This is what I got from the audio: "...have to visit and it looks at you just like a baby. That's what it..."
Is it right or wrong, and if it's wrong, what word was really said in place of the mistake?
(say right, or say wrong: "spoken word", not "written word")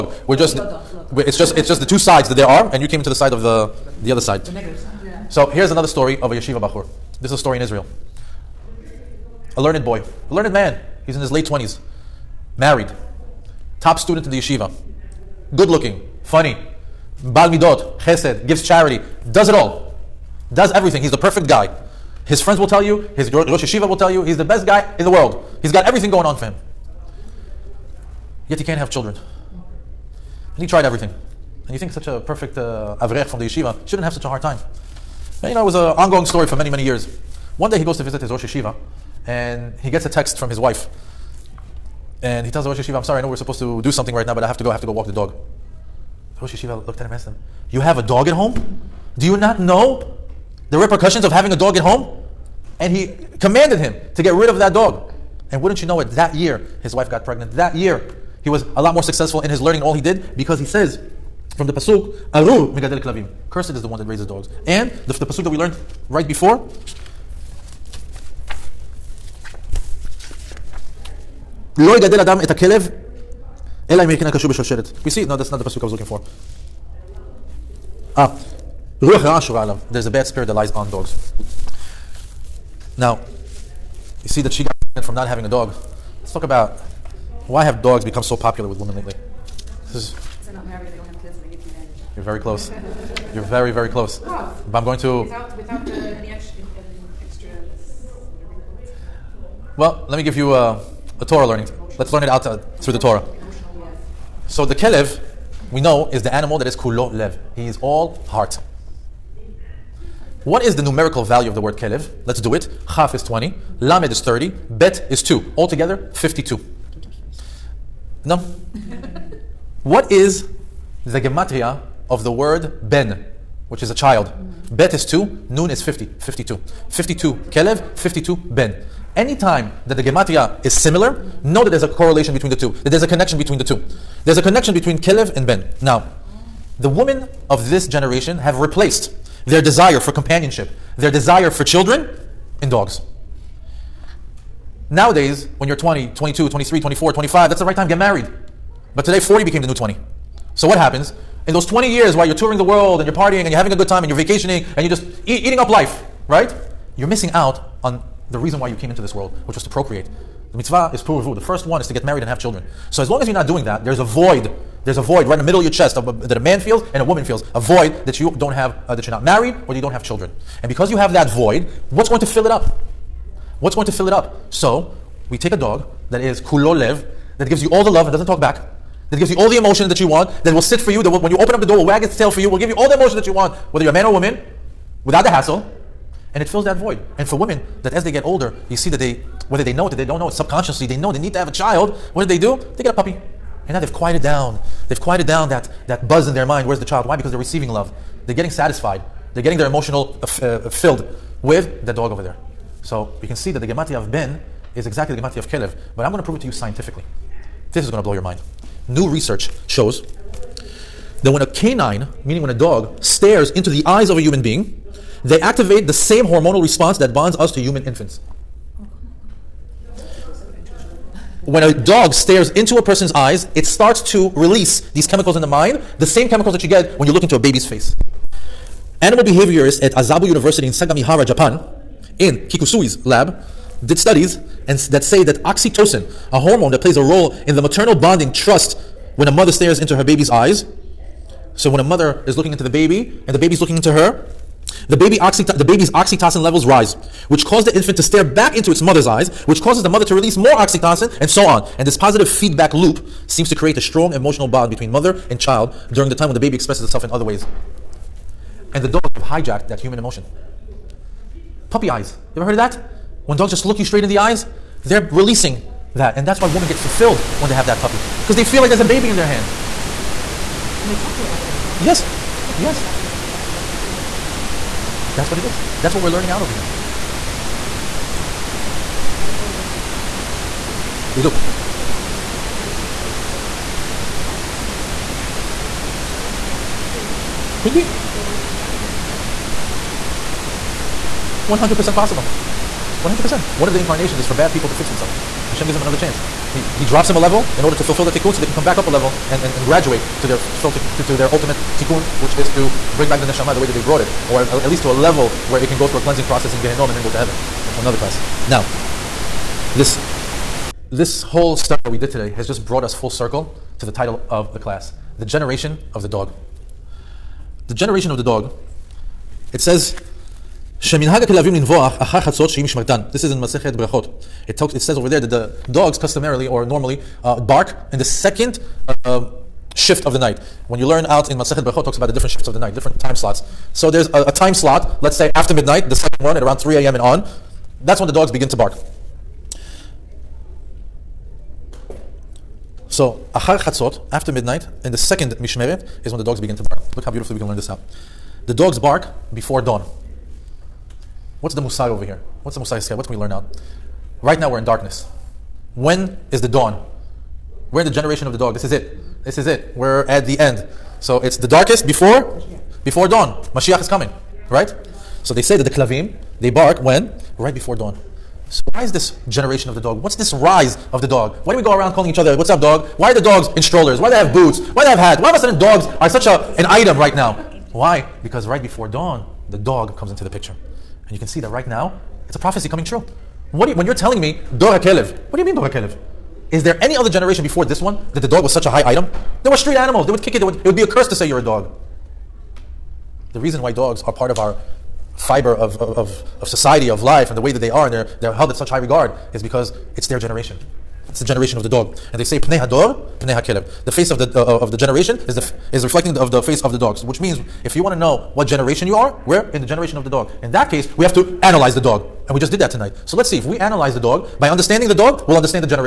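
wrong: "intuit", not "visit".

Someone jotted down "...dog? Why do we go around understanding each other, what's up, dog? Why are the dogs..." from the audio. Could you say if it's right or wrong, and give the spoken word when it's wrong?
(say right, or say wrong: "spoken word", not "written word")
wrong: "calling", not "understanding".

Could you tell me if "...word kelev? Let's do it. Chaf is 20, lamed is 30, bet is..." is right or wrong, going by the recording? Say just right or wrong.
right.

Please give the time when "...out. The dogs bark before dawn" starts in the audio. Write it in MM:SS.
05:47.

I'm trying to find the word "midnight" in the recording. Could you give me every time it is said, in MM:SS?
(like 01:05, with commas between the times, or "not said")
05:35, 05:44.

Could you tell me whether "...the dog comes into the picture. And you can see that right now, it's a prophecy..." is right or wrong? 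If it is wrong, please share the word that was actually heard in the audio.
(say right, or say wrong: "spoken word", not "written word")
right.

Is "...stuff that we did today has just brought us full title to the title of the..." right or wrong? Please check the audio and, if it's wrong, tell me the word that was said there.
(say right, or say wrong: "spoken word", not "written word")
wrong: "circle", not "title".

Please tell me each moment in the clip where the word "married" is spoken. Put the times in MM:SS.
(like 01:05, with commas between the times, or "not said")
00:12, 02:27, 02:42, 02:49.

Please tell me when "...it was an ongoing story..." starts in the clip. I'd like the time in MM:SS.
00:35.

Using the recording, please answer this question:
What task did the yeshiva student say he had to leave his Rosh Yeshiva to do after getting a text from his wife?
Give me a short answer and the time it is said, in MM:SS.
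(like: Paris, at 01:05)
Walk the dog, at 00:44.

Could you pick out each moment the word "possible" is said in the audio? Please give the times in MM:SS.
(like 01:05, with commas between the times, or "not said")
04:51.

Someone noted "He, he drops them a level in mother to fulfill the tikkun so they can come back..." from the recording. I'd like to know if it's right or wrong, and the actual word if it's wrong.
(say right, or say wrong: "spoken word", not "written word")
wrong: "order", not "mother".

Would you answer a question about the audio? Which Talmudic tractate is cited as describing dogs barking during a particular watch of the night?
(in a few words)
Berachot.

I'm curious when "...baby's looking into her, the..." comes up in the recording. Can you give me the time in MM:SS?
04:03.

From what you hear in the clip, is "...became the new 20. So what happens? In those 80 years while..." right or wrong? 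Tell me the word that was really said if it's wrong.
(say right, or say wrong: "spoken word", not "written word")
wrong: "20", not "80".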